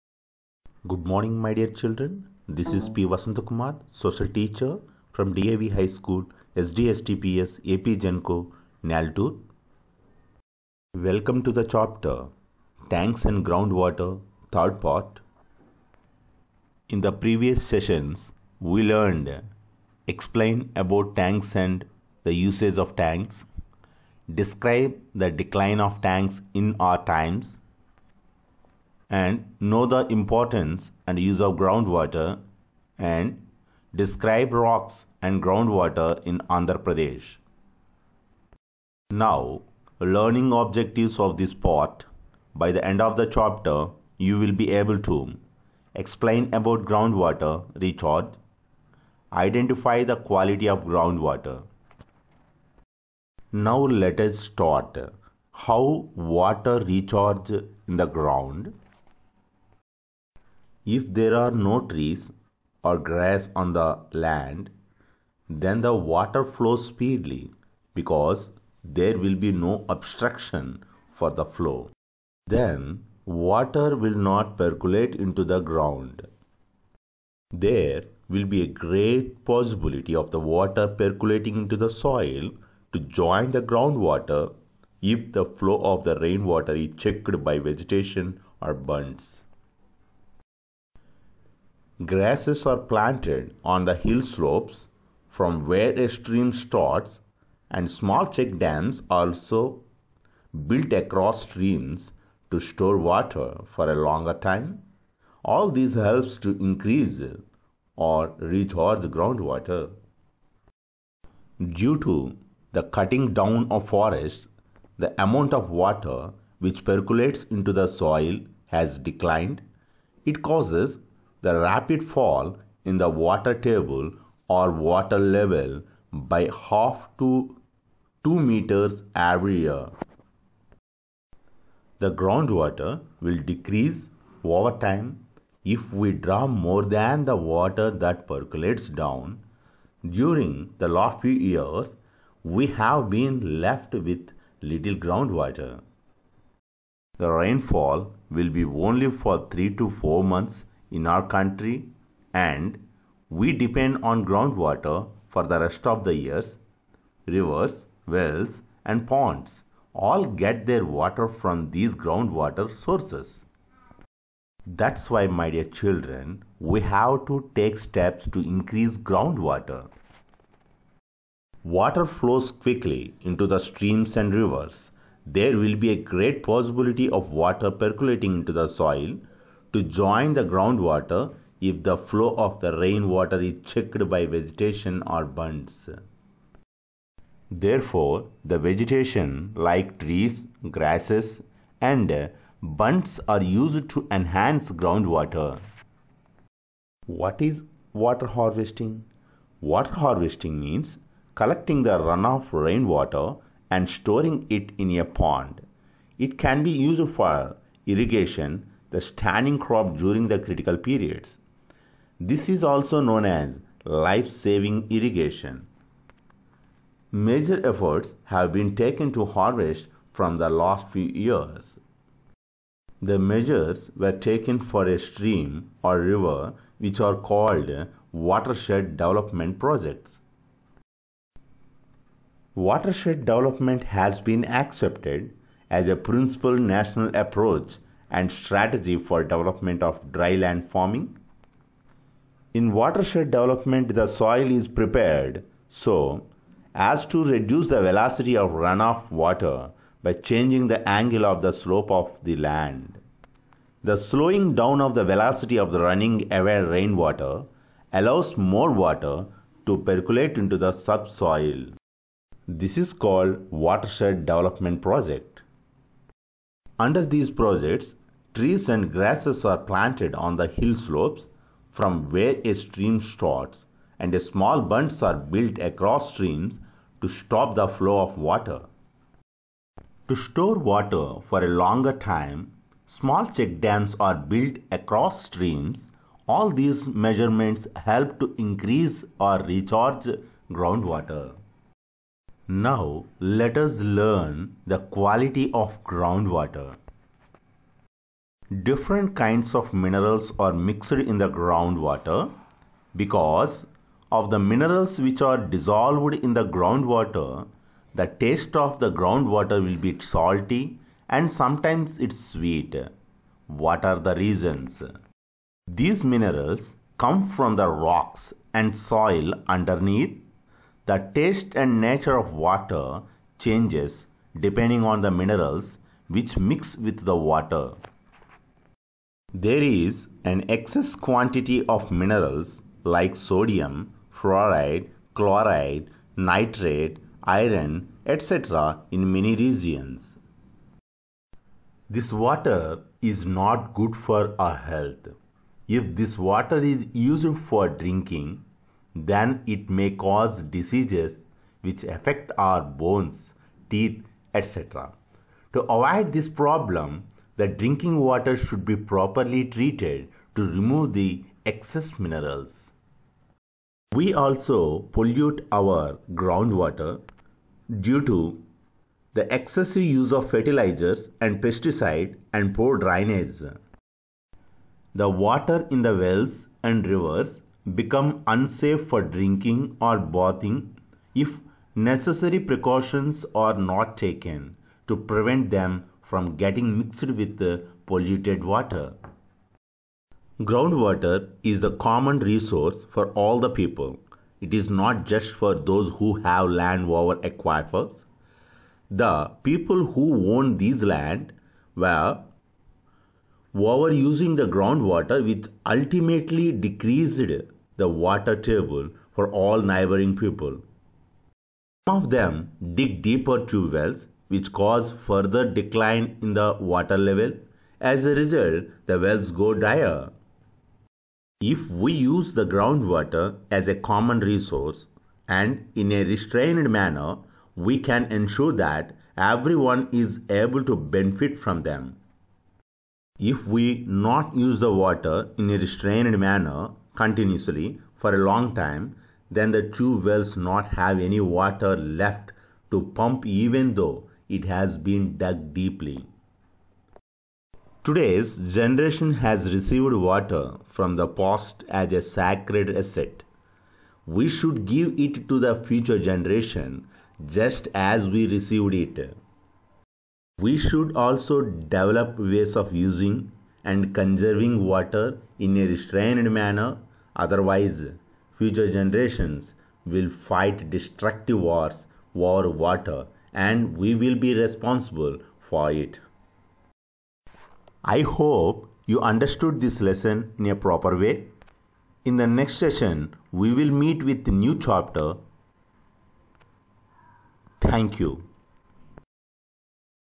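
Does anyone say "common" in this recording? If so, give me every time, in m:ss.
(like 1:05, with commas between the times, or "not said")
6:31, 7:03.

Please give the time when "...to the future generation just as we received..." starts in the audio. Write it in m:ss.
7:35.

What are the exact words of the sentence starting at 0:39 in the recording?
Now, learning objectives of this part.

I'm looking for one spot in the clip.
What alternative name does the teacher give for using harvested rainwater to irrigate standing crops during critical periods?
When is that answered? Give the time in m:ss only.
3:33.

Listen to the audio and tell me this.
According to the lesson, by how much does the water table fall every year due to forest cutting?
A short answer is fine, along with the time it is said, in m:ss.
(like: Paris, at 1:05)
half to 2 meters, at 2:06.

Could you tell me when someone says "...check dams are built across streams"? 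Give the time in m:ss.
4:43.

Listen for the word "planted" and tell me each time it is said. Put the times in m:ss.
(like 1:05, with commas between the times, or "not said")
1:32, 4:29.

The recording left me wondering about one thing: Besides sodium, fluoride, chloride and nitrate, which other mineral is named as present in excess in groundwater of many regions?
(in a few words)
iron.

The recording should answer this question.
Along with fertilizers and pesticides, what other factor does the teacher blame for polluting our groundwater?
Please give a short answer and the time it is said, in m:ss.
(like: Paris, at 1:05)
poor drainage, at 6:12.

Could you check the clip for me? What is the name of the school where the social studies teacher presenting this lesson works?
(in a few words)
DAV High School.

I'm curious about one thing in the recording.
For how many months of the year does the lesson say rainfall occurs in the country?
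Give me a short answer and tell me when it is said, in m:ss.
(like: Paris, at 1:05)
3 to 4 months, at 2:29.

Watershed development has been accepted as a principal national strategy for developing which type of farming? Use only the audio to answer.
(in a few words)
dry land farming.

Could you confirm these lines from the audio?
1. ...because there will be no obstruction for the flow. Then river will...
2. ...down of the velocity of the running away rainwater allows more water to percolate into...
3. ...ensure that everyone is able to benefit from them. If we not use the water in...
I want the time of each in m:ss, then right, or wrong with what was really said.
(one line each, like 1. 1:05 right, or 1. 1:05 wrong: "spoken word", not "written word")
1. 1:07 wrong: "water", not "river"
2. 4:14 right
3. 7:08 right.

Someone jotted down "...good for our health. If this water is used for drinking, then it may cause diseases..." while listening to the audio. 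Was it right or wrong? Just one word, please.
right.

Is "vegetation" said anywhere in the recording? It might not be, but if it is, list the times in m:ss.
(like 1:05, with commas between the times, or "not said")
1:27, 3:04, 3:08.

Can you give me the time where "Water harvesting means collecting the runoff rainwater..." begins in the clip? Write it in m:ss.
3:19.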